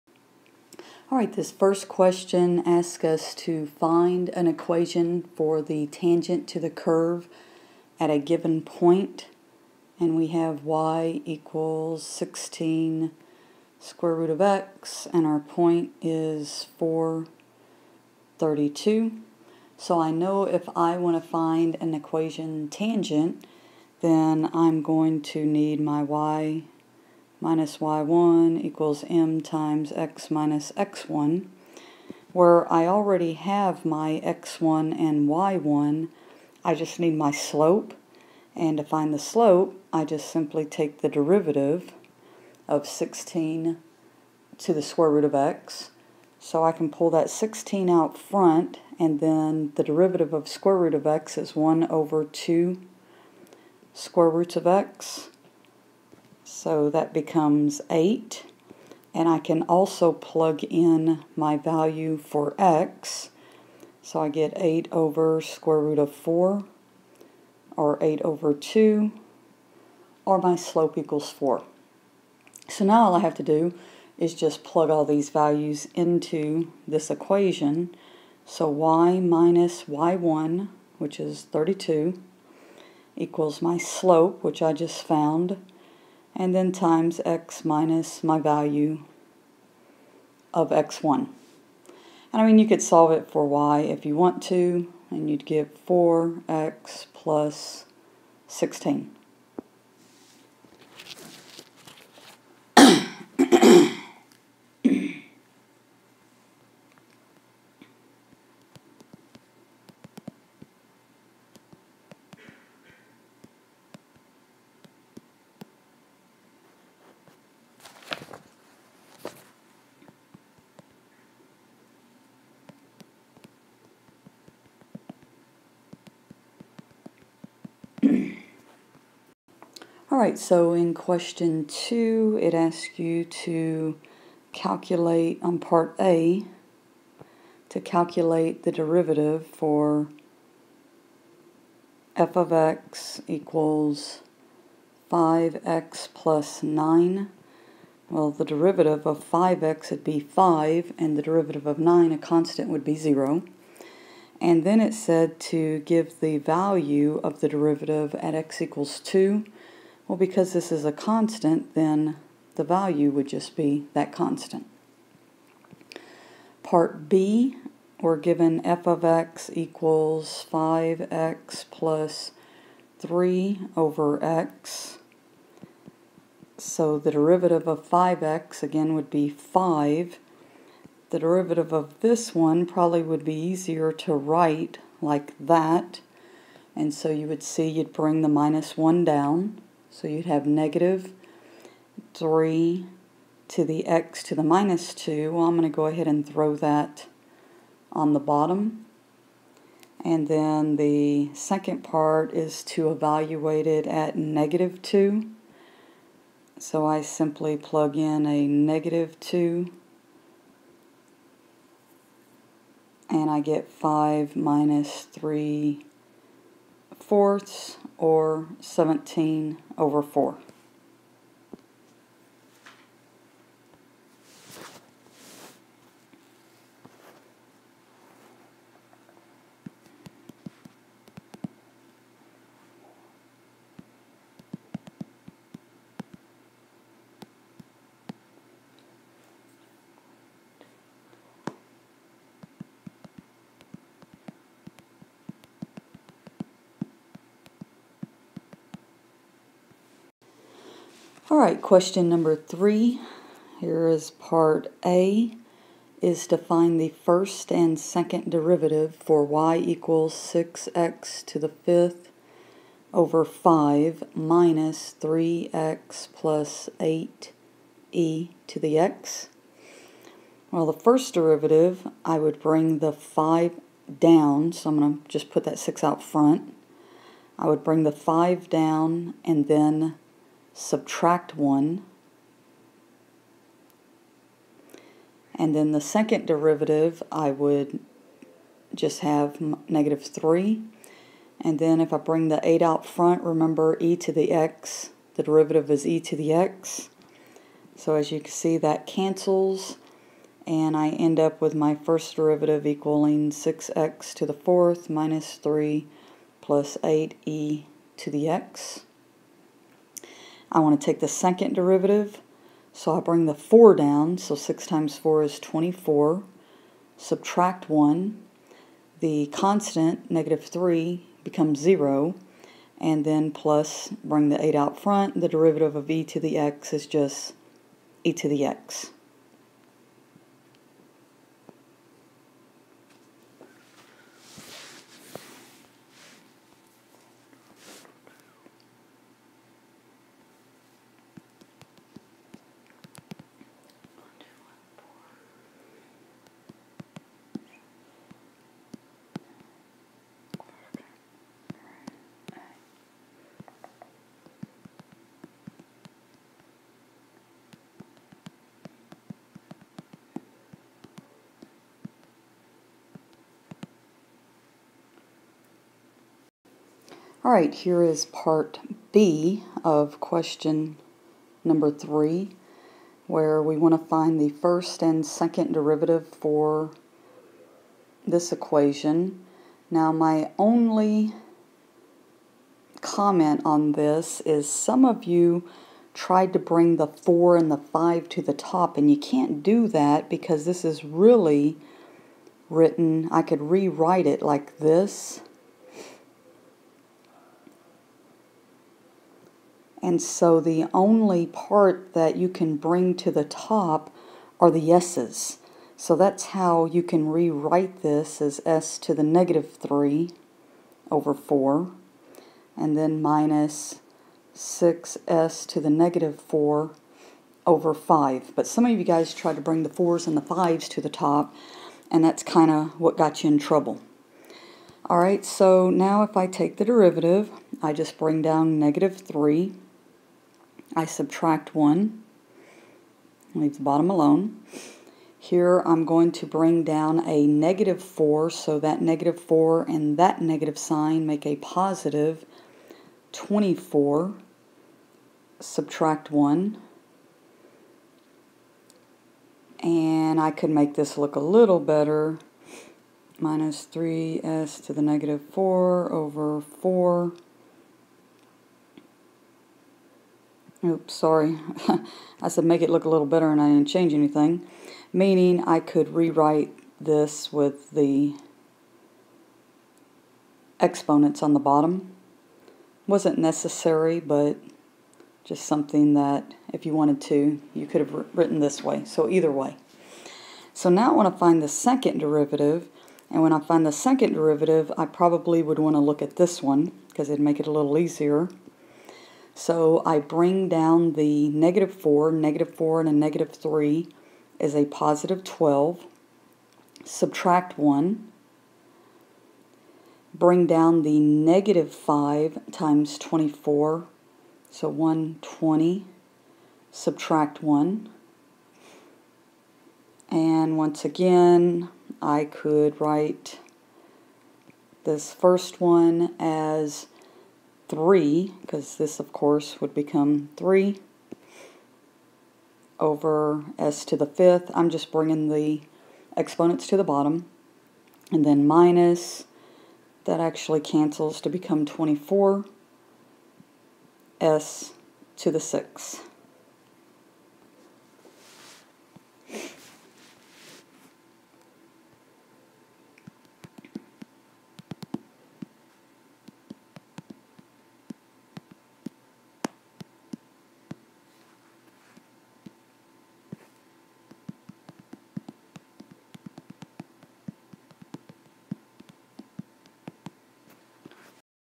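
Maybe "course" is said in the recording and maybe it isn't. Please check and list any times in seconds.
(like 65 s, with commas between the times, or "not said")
519 s.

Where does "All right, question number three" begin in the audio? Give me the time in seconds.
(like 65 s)
251 s.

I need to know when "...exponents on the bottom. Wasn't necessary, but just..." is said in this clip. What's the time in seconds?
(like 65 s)
470 s.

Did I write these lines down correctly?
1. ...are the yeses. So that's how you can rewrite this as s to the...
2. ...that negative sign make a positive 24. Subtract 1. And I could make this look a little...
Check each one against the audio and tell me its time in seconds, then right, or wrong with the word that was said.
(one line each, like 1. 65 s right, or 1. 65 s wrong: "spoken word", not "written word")
1. 404 s right
2. 439 s right.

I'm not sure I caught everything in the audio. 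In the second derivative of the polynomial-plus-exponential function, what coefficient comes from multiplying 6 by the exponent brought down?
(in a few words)
24.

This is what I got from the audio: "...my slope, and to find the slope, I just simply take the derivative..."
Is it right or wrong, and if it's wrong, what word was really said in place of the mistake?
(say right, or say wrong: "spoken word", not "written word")
right.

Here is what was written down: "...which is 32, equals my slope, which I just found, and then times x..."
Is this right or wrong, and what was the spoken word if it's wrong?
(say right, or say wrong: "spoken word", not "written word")
right.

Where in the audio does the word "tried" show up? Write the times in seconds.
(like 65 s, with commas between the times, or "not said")
385 s, 419 s.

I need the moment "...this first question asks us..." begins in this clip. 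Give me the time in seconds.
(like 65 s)
1 s.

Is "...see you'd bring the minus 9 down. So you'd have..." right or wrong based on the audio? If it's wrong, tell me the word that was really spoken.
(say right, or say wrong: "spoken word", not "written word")
wrong: "1", not "9".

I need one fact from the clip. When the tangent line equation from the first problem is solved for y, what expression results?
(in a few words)
4x + 16.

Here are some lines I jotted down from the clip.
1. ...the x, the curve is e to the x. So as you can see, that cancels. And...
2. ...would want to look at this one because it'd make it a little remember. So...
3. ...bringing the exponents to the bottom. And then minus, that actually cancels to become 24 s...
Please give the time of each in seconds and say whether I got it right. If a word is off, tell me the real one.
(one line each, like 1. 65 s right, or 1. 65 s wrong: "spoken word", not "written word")
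1. 294 s wrong: "derivative", not "curve"
2. 485 s wrong: "easier", not "remember"
3. 524 s right.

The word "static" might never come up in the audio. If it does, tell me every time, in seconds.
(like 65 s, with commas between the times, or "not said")
not said.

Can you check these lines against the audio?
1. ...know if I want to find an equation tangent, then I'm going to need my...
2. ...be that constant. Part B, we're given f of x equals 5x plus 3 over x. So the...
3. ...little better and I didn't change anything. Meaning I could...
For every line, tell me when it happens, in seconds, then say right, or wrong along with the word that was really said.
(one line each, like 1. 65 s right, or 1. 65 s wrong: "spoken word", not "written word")
1. 20 s right
2. 163 s right
3. 462 s right.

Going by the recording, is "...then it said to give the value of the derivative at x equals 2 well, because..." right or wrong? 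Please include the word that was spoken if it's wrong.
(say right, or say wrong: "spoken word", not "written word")
right.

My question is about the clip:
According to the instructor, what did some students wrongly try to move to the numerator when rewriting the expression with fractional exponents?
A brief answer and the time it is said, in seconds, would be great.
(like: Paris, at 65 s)
the 4 and the 5, at 386 s.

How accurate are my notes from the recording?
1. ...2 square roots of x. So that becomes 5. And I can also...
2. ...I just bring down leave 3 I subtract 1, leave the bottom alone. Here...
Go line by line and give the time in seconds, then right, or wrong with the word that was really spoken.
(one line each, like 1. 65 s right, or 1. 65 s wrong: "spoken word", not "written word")
1. 52 s wrong: "8", not "5"
2. 427 s wrong: "negative", not "leave".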